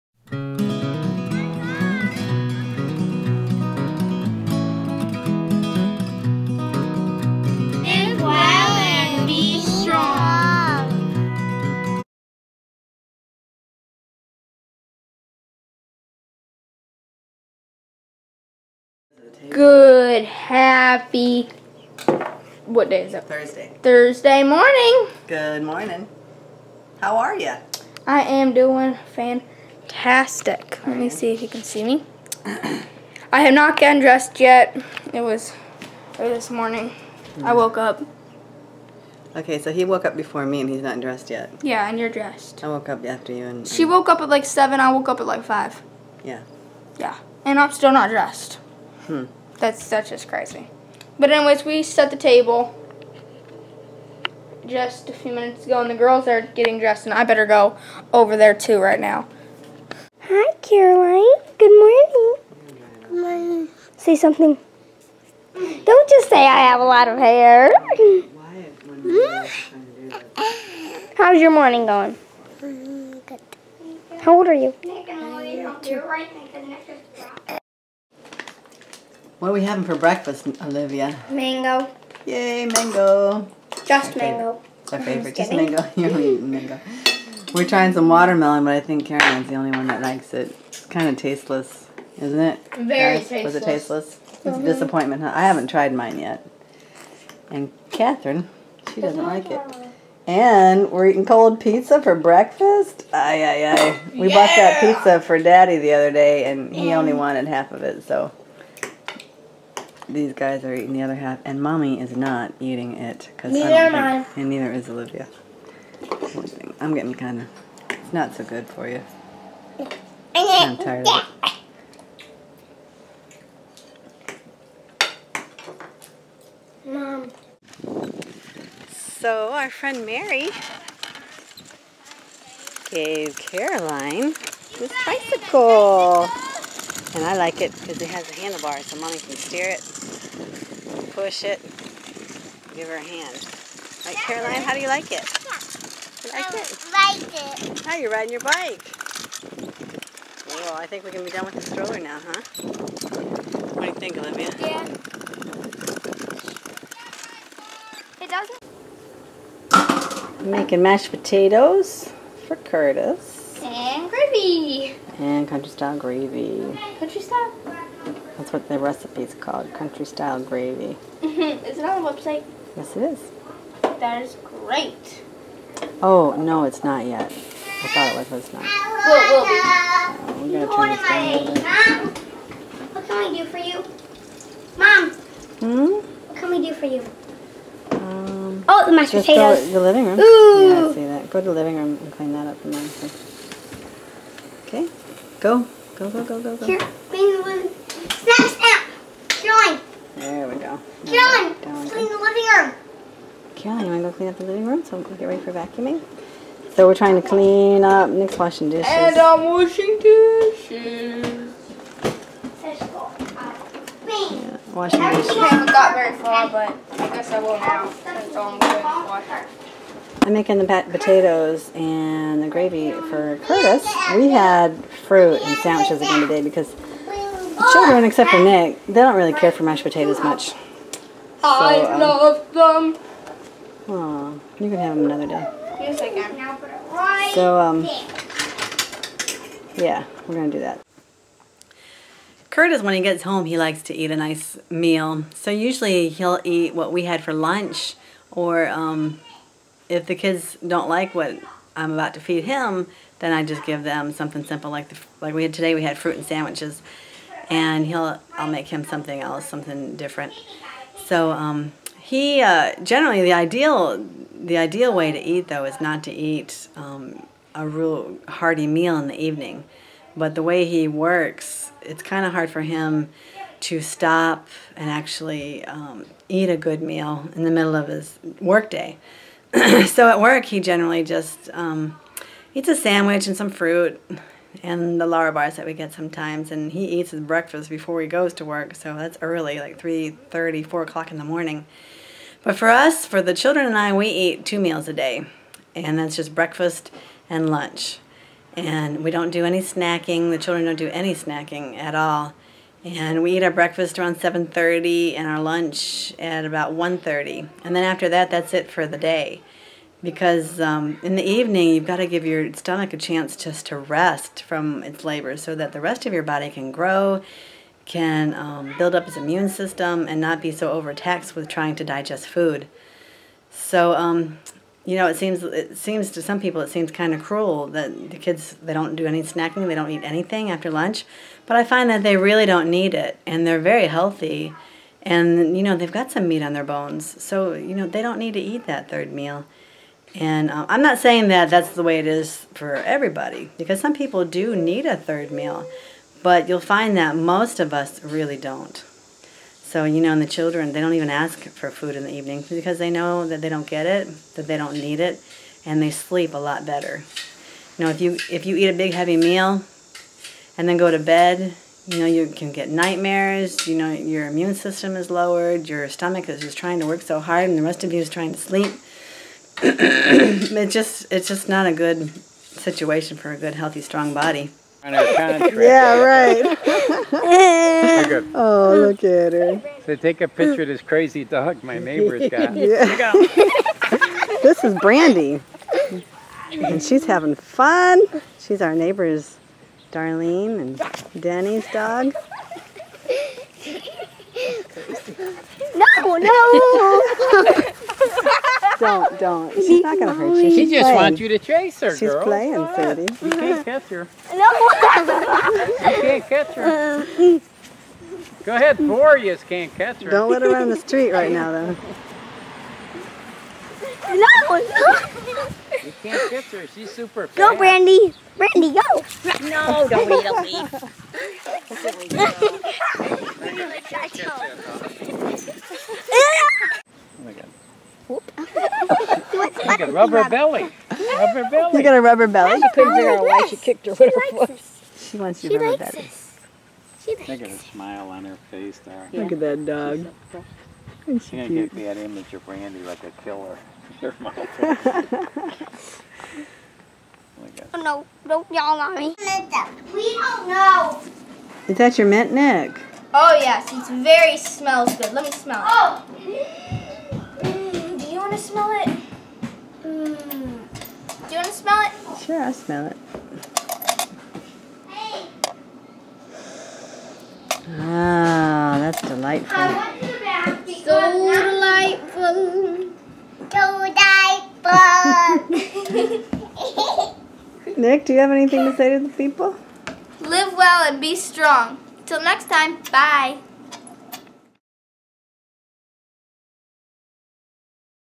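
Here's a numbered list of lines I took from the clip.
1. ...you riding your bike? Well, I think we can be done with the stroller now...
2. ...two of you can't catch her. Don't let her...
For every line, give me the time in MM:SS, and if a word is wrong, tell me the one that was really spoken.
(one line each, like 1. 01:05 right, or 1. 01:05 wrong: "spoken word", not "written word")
1. 02:27 right
2. 06:48 wrong: "four", not "two".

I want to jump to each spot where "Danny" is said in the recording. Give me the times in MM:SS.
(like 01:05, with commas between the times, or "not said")
06:31.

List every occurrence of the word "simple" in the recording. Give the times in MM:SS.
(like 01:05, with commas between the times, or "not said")
04:14.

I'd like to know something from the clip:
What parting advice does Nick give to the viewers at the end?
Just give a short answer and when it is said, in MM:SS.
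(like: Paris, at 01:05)
Live well and be strong, at 08:00.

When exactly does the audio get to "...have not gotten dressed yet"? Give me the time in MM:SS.
00:33.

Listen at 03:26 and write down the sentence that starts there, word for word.
So we're trying to clean up Nick's washing dishes.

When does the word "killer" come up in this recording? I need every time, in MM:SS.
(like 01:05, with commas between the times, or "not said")
07:23.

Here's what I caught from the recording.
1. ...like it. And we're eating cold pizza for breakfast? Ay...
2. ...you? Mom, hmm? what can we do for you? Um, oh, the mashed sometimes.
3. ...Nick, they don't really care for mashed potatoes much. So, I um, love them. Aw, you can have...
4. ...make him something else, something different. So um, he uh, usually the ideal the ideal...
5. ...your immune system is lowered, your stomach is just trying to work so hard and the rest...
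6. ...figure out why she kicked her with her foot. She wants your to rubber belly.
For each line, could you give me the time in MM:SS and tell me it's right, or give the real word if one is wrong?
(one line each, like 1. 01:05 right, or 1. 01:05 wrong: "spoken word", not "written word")
1. 01:39 right
2. 03:03 wrong: "potatoes", not "sometimes"
3. 03:48 right
4. 04:18 wrong: "generally", not "usually"
5. 06:03 right
6. 07:12 right.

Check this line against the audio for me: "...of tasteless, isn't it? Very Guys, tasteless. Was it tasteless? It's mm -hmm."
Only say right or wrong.
right.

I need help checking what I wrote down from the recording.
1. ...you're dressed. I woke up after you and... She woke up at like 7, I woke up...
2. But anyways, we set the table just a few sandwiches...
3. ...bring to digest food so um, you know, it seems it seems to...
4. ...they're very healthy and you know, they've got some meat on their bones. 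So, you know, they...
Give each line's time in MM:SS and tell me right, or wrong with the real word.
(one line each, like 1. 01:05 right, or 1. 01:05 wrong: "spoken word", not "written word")
1. 00:41 right
2. 00:51 wrong: "minutes", not "sandwiches"
3. 05:21 wrong: "trying", not "bring"
4. 05:33 right.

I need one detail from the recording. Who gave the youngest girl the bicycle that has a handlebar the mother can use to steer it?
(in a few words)
Mary.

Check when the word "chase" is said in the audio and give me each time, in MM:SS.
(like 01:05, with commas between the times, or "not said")
06:41.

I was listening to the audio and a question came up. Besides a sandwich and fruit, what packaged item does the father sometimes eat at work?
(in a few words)
Lara bars.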